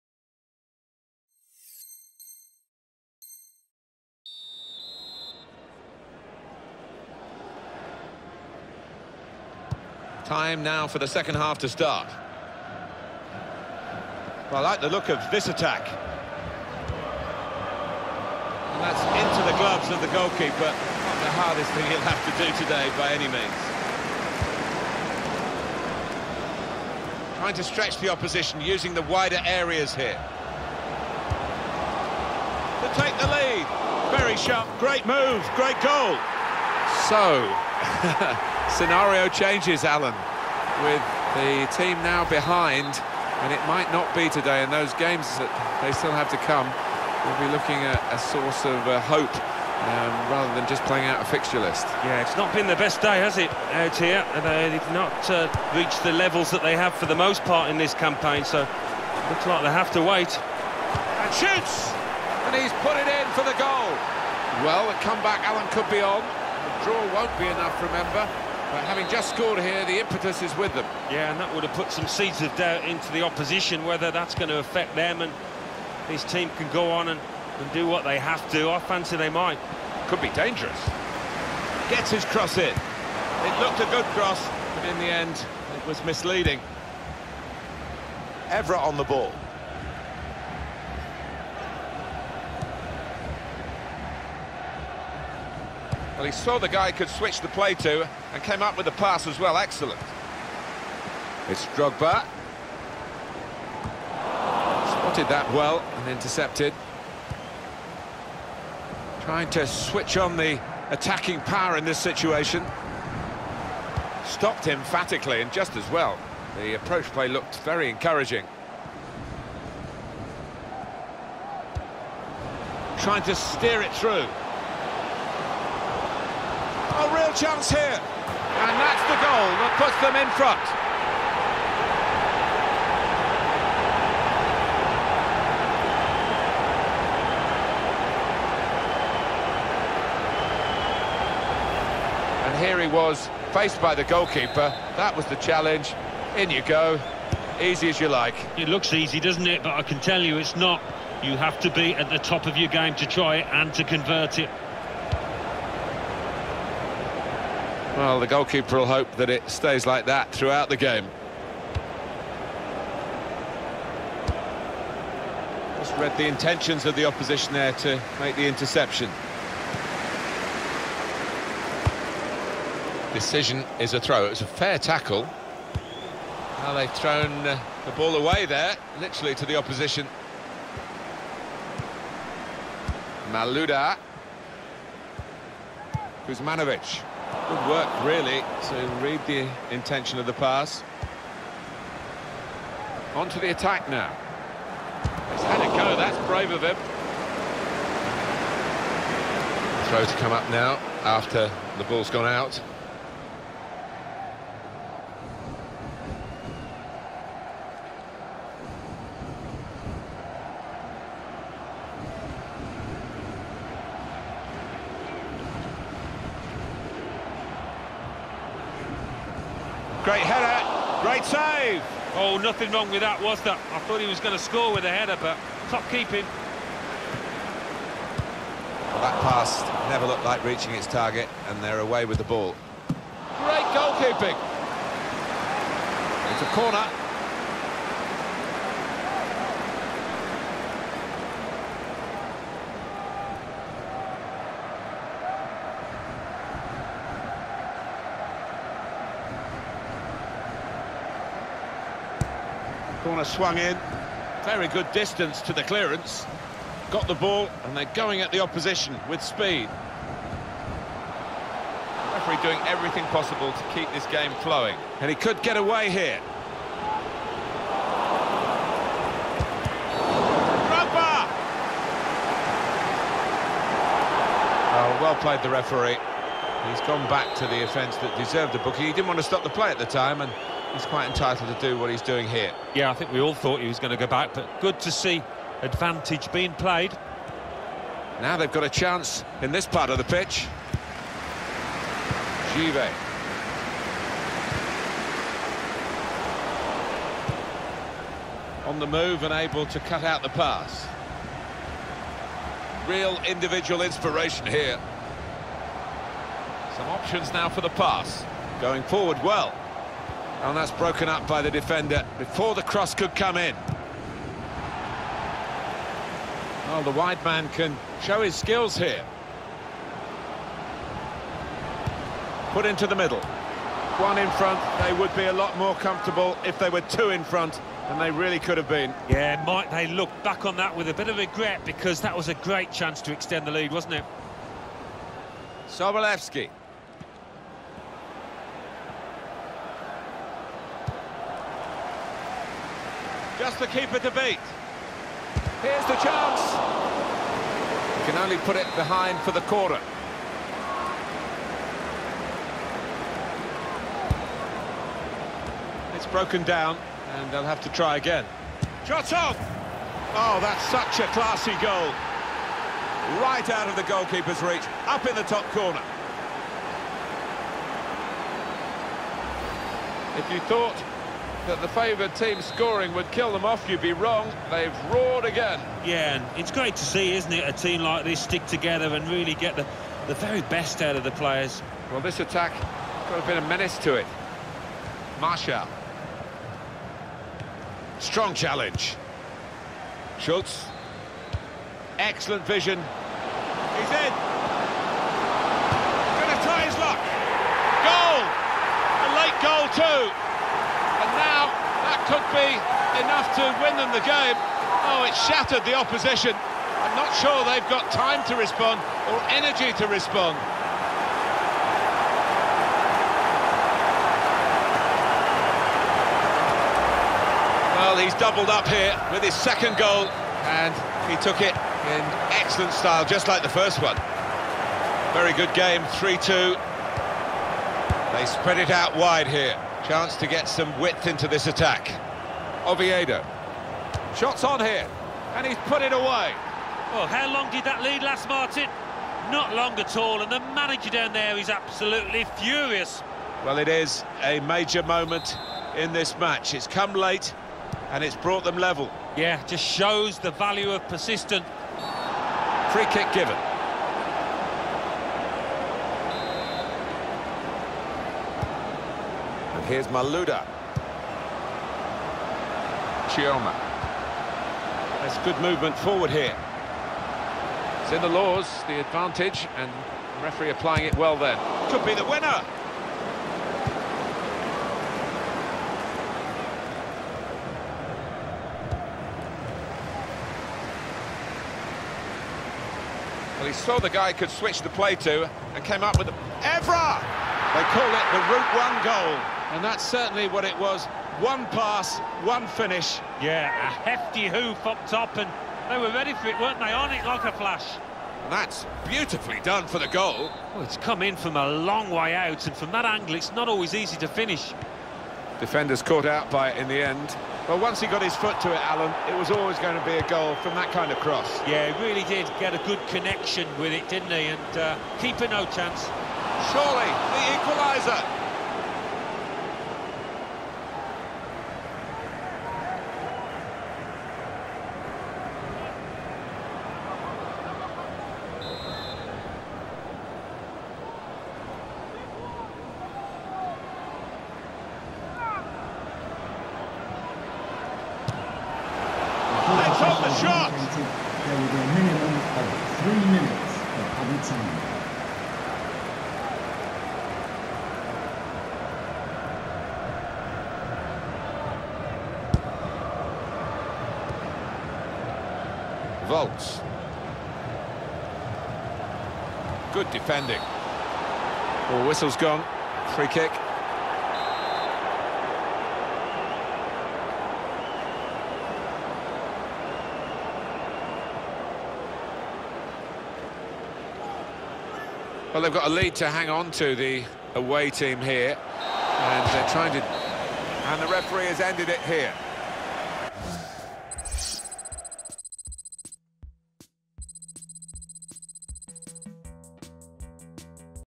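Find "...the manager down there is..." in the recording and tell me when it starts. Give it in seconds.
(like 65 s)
440 s.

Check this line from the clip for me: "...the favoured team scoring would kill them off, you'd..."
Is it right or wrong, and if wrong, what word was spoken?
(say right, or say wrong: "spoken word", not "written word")
right.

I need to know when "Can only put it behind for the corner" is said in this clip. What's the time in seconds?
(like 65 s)
348 s.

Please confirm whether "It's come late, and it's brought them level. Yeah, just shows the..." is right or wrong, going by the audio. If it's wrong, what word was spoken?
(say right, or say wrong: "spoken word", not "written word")
right.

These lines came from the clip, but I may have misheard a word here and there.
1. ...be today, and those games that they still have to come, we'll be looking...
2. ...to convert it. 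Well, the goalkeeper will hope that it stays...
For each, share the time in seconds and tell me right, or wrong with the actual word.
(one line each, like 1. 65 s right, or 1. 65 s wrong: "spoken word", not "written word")
1. 44 s right
2. 153 s right.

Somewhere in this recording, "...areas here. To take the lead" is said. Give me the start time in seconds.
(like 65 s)
29 s.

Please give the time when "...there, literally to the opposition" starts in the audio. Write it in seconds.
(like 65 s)
178 s.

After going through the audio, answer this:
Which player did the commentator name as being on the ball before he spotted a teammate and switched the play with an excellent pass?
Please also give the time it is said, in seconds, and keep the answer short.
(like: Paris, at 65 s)
Everett, at 88 s.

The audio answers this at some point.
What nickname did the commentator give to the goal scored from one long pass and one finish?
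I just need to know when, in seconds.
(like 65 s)
488 s.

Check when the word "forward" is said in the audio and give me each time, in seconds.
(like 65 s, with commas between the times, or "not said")
308 s, 465 s.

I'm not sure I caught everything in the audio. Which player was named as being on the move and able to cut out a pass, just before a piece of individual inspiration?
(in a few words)
Givet.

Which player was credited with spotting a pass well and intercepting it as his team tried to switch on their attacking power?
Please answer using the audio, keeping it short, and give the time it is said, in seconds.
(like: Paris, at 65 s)
Drogba, at 101 s.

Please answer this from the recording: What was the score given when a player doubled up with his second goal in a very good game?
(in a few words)
3-2.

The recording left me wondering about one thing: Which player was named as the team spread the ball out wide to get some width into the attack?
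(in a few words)
Oviedo.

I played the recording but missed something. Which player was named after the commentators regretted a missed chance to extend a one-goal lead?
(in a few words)
Sobolewski.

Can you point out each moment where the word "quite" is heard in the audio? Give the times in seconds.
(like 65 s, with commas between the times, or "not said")
280 s.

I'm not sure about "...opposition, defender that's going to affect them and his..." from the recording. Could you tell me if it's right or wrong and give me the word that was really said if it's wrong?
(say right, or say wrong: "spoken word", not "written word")
wrong: "whether", not "defender".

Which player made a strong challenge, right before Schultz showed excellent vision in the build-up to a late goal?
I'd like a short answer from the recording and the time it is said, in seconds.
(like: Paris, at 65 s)
Marshall, at 385 s.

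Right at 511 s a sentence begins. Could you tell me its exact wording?
Yeah, he really did get a good connection with it, didn't he?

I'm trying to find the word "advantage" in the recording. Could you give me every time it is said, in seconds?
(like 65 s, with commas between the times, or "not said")
285 s, 468 s.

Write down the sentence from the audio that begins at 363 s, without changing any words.
Right out of the goalkeeper's reach, up in the top corner.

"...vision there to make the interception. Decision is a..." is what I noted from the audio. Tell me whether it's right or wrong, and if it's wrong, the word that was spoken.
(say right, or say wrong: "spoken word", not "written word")
wrong: "opposition", not "vision".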